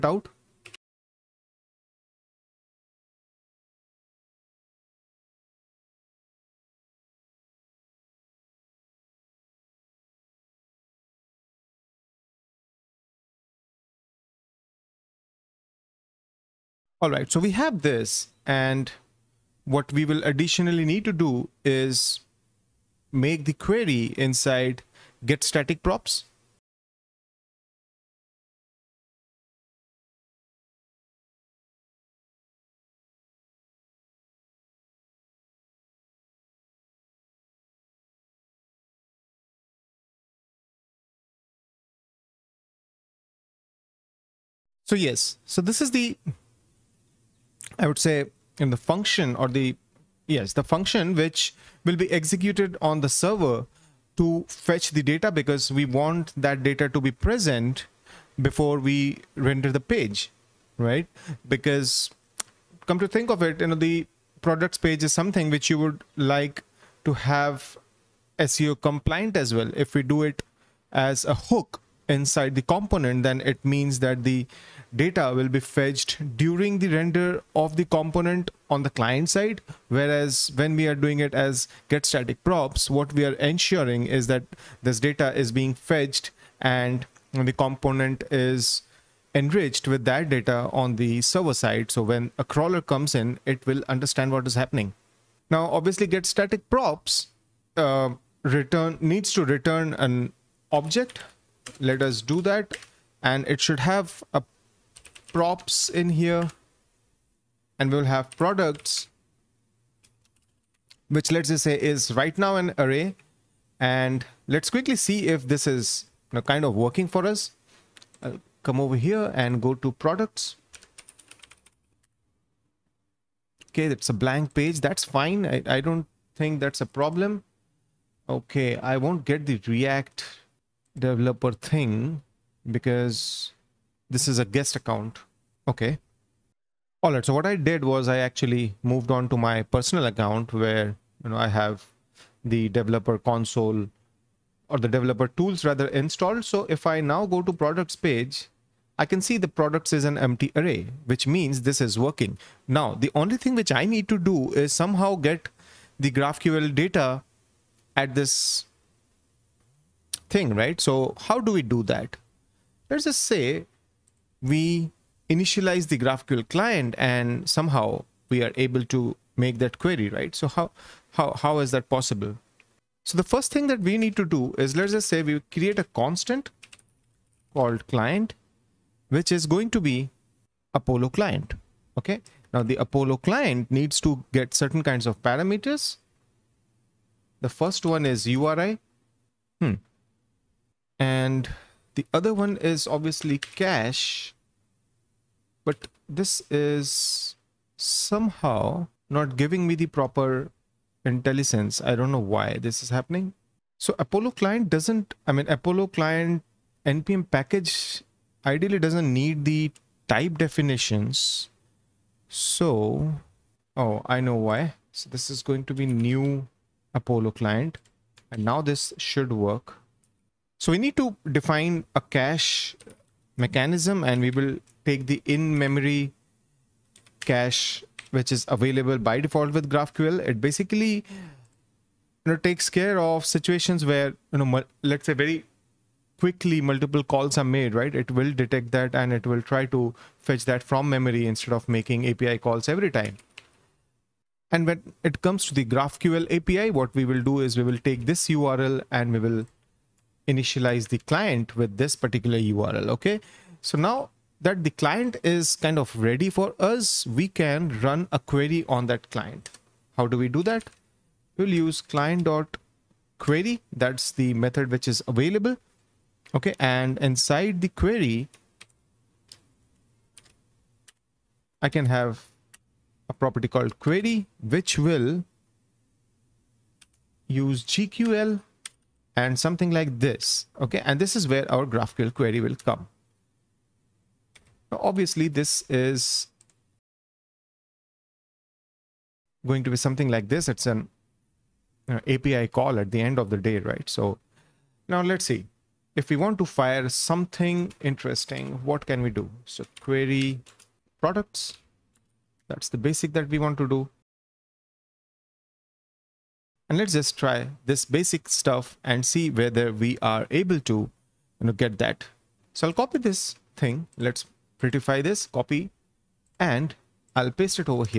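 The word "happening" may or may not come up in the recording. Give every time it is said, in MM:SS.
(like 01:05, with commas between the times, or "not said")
01:34, 03:22.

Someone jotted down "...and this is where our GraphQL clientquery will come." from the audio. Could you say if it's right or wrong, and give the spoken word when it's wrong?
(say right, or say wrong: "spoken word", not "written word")
wrong: "query", not "clientquery".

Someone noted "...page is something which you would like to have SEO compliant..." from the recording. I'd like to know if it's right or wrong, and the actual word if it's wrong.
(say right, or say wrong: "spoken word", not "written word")
right.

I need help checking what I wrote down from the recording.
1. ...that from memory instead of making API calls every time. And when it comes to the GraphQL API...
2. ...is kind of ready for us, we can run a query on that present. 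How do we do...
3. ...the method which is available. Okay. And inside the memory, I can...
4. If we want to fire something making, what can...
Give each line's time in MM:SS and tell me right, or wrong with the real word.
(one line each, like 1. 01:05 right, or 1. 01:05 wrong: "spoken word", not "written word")
1. 04:00 right
2. 04:15 wrong: "client", not "present"
3. 04:24 wrong: "query", not "memory"
4. 04:55 wrong: "interesting", not "making".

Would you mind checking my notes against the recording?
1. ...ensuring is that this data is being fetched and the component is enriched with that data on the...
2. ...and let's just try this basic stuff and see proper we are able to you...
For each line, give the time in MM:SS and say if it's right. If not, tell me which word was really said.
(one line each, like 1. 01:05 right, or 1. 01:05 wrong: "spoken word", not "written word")
1. 01:23 right
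2. 05:06 wrong: "whether", not "proper".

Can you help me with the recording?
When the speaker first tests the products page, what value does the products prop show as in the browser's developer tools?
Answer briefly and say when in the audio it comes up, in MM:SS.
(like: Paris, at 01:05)
empty array, at 02:30.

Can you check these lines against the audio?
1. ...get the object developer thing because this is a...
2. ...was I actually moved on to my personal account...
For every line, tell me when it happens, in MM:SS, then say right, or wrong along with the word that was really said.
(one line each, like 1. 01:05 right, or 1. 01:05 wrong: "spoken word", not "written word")
1. 02:09 wrong: "react", not "object"
2. 02:17 right.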